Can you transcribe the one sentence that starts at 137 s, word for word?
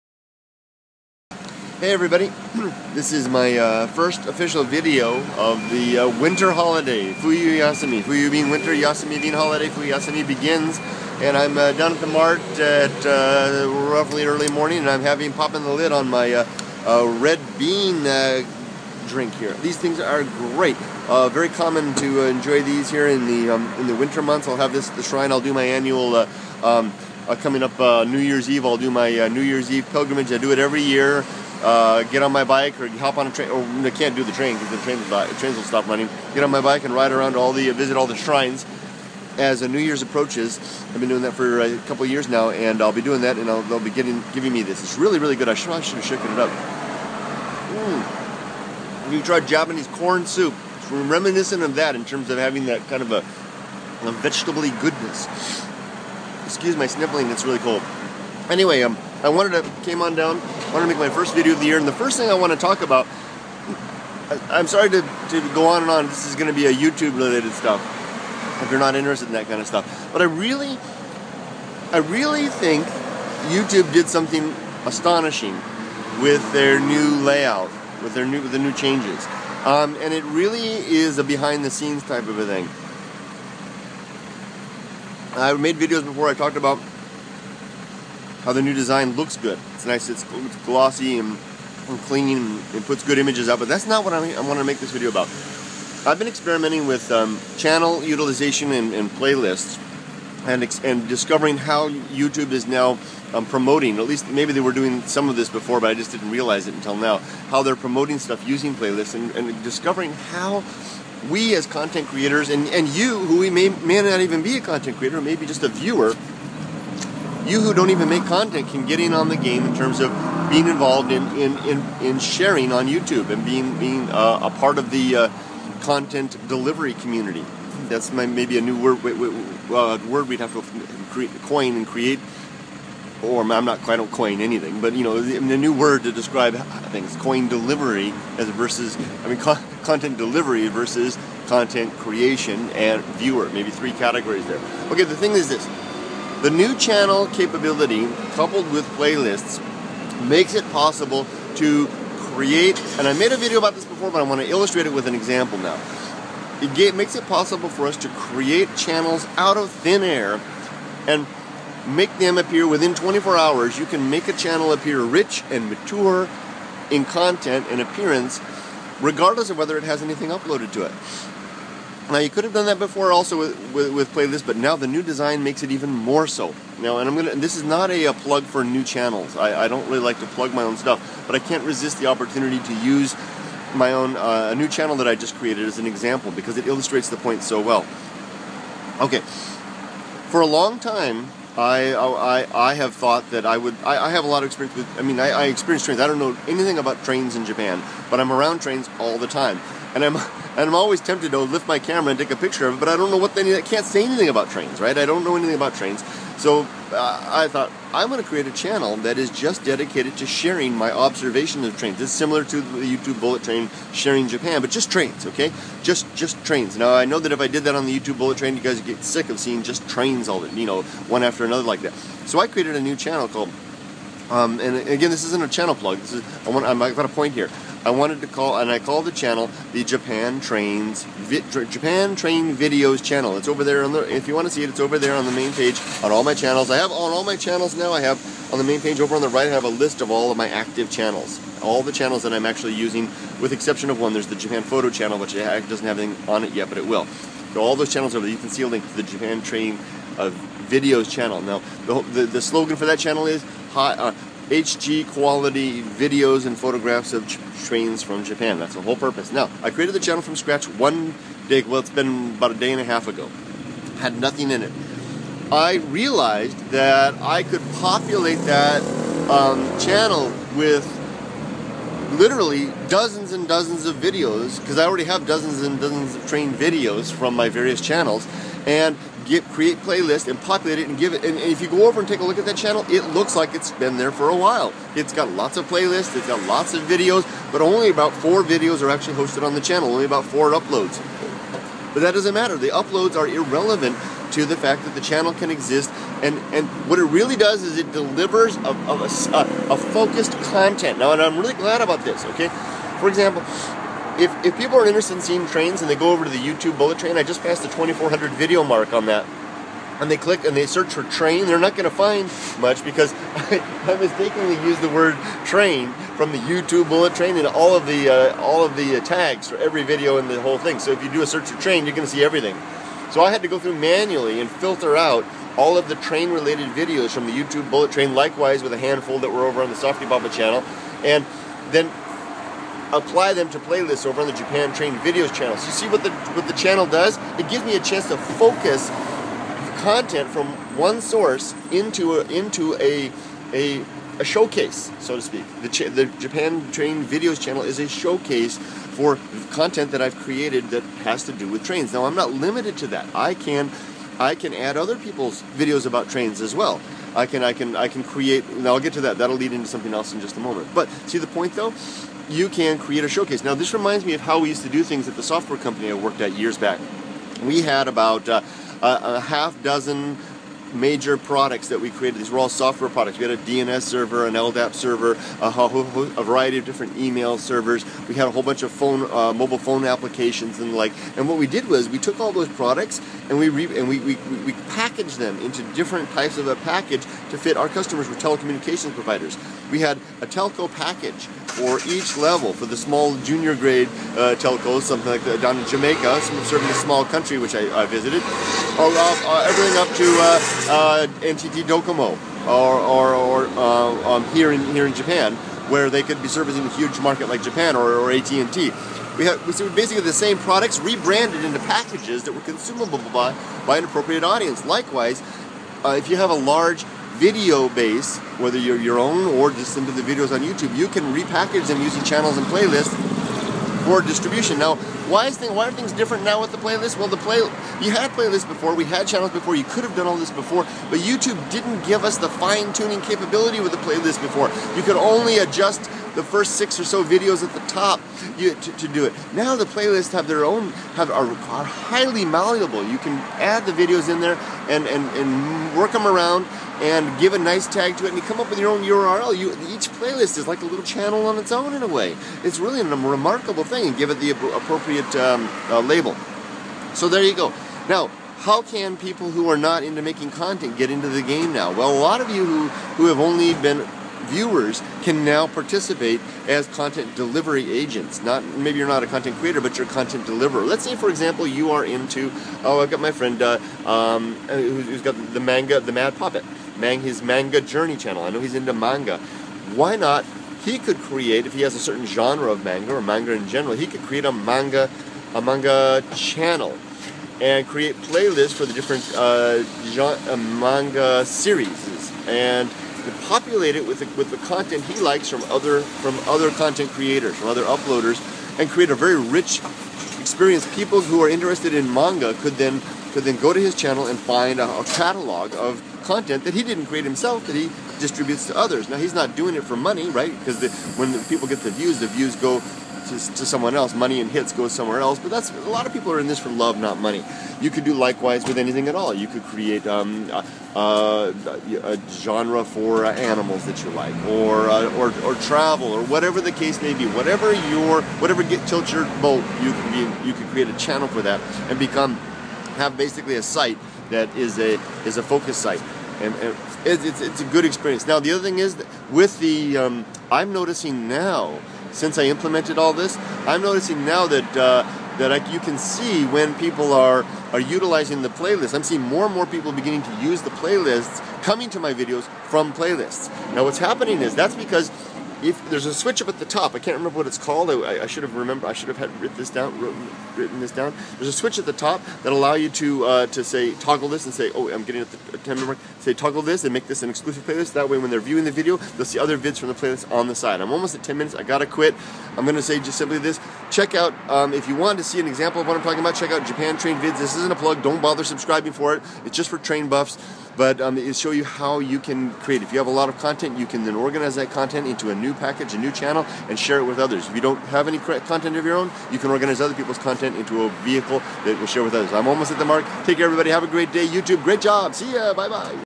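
Coin delivery as versus, I mean, content delivery versus content creation and viewer.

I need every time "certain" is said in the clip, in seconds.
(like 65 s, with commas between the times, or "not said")
481 s.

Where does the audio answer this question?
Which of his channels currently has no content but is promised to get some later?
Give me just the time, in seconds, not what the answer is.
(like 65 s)
244 s.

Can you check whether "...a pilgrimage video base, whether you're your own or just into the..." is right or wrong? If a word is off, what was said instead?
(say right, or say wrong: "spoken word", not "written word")
wrong: "large", not "pilgrimage".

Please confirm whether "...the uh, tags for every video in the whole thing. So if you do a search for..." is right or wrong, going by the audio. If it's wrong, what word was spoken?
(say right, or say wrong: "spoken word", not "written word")
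right.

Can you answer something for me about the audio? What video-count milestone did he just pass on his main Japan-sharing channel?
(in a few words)
2400.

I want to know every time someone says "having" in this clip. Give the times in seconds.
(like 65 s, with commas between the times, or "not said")
15 s, 52 s.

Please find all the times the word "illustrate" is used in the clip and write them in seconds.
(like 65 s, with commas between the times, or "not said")
154 s, 186 s.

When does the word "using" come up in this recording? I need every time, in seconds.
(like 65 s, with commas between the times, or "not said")
108 s, 242 s, 421 s.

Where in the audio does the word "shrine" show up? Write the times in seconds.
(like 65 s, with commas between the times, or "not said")
25 s, 38 s.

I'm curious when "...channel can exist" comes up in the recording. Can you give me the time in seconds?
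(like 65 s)
295 s.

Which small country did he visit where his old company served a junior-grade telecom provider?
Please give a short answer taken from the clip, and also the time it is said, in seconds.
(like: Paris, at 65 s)
Jamaica, at 395 s.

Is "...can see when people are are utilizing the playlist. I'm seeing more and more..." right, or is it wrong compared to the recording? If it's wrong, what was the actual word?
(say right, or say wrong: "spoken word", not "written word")
right.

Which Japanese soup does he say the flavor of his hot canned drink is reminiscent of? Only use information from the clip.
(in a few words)
corn soup.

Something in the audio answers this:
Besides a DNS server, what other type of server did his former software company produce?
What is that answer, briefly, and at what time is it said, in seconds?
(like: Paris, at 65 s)
LDAP server, at 374 s.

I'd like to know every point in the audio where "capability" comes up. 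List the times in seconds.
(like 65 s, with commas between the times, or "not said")
147 s, 433 s.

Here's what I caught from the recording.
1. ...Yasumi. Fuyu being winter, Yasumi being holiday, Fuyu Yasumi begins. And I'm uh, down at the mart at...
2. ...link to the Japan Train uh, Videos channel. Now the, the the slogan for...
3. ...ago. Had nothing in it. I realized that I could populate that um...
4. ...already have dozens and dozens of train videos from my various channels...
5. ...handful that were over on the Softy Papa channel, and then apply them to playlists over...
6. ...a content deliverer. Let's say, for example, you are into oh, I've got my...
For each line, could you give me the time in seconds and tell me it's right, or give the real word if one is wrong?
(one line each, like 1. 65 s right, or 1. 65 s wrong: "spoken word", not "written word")
1. 7 s right
2. 248 s right
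3. 263 s right
4. 274 s right
5. 328 s right
6. 469 s right.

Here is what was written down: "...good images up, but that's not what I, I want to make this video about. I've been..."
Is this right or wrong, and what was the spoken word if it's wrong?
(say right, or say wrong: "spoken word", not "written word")
right.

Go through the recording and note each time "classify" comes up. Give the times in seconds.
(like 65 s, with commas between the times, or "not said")
not said.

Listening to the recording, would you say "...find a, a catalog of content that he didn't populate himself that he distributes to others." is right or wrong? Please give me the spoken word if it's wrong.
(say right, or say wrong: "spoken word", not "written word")
wrong: "create", not "populate".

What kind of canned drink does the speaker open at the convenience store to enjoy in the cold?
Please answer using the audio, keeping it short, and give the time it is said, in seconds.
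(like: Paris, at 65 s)
red bean drink, at 17 s.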